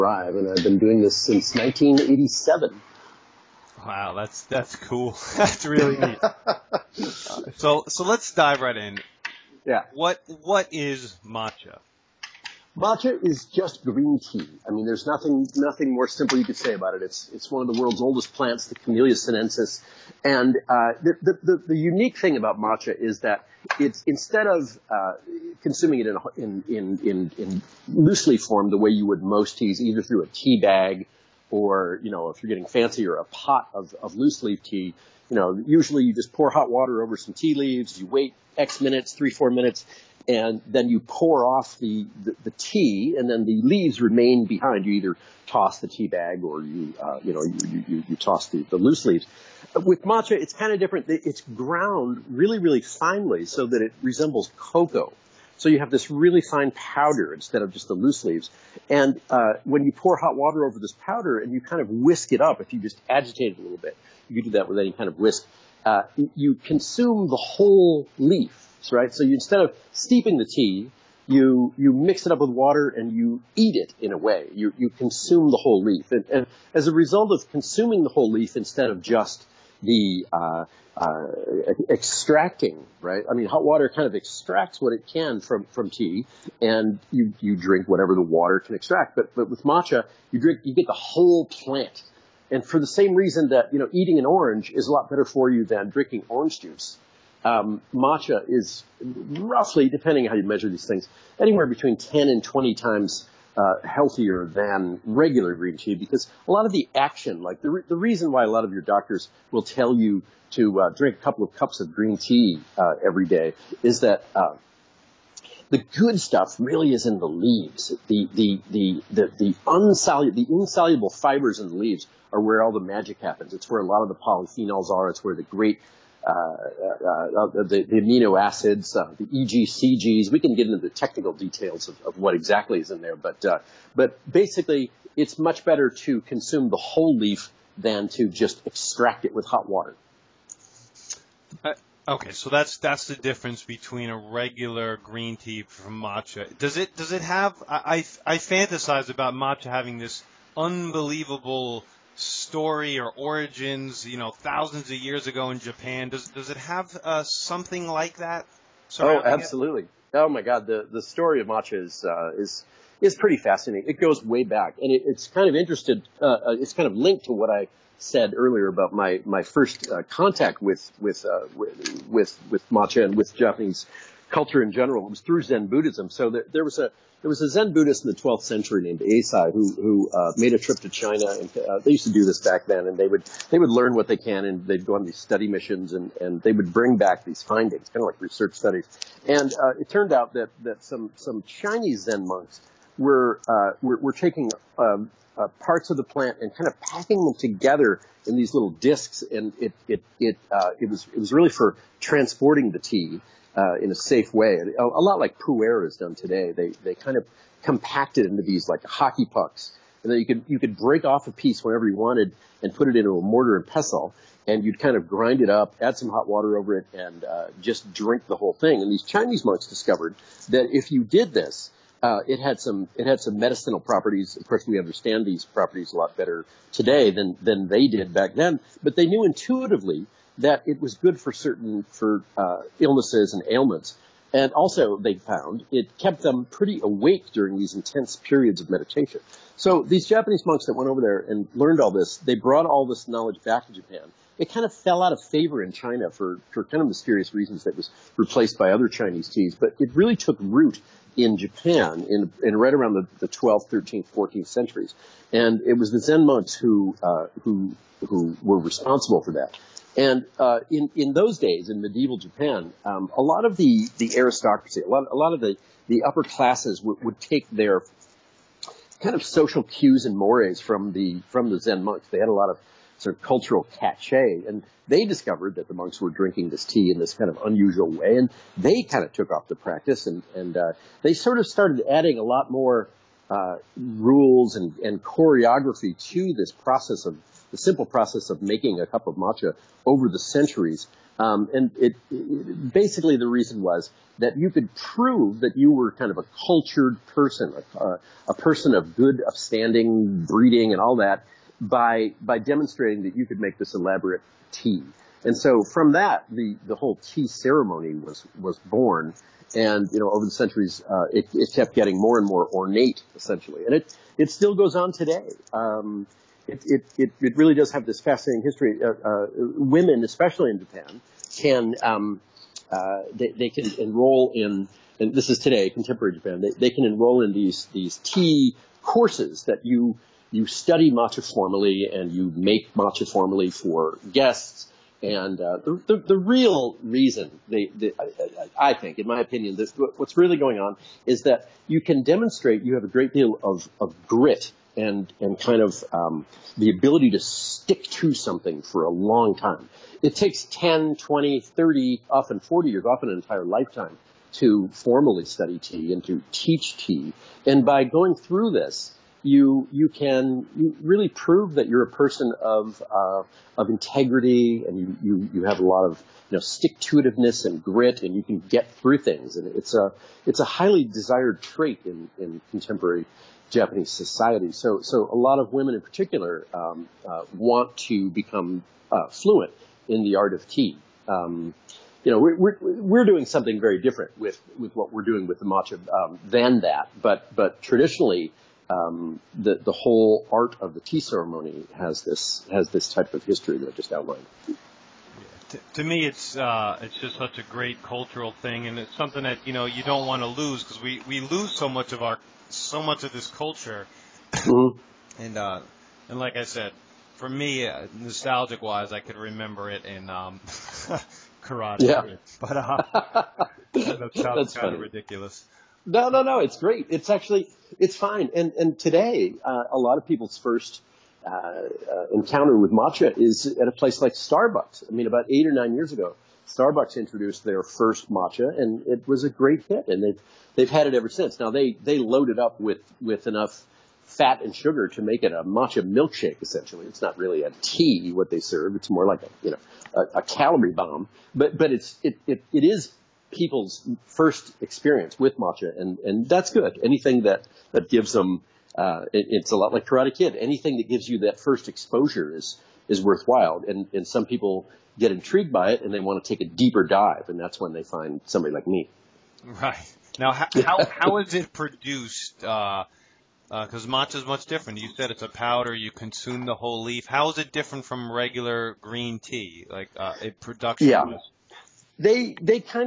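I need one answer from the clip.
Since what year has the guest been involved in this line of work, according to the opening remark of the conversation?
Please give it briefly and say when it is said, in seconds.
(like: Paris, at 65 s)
1987, at 1 s.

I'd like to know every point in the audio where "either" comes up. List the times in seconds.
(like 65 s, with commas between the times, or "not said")
29 s, 44 s.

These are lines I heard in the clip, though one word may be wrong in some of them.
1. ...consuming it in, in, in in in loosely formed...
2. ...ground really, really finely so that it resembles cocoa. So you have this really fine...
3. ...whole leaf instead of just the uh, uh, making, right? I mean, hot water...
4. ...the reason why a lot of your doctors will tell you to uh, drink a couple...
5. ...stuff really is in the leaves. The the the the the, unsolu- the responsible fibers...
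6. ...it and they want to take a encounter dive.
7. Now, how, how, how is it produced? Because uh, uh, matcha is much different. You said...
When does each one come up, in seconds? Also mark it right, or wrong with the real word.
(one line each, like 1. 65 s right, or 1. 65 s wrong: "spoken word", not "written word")
1. 25 s right
2. 51 s right
3. 78 s wrong: "extracting", not "making"
4. 107 s right
5. 116 s wrong: "insoluble", not "responsible"
6. 455 s wrong: "deeper", not "encounter"
7. 460 s right.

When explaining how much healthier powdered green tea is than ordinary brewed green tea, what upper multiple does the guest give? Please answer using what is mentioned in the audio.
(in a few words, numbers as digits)
20 times.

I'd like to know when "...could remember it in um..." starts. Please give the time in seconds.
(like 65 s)
408 s.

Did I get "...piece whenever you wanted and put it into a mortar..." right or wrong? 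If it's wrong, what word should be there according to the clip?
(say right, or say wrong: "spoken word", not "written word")
right.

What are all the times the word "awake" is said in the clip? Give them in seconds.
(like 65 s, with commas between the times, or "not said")
236 s.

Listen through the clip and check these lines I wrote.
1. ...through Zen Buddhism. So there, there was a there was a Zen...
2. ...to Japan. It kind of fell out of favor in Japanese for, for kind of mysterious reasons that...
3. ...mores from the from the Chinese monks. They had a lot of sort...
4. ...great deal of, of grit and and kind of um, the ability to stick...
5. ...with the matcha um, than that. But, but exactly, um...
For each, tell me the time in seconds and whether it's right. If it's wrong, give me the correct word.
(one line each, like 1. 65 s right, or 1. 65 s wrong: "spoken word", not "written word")
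1. 175 s right
2. 243 s wrong: "China", not "Japanese"
3. 270 s wrong: "Zen", not "Chinese"
4. 342 s right
5. 385 s wrong: "traditionally", not "exactly".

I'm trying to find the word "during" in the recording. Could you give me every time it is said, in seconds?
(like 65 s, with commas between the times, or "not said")
237 s.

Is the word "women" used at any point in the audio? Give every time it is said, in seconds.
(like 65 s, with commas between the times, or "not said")
319 s, 375 s.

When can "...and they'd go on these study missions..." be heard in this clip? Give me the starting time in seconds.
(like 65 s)
184 s.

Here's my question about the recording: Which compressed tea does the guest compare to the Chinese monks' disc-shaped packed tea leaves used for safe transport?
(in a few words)
Pu'er.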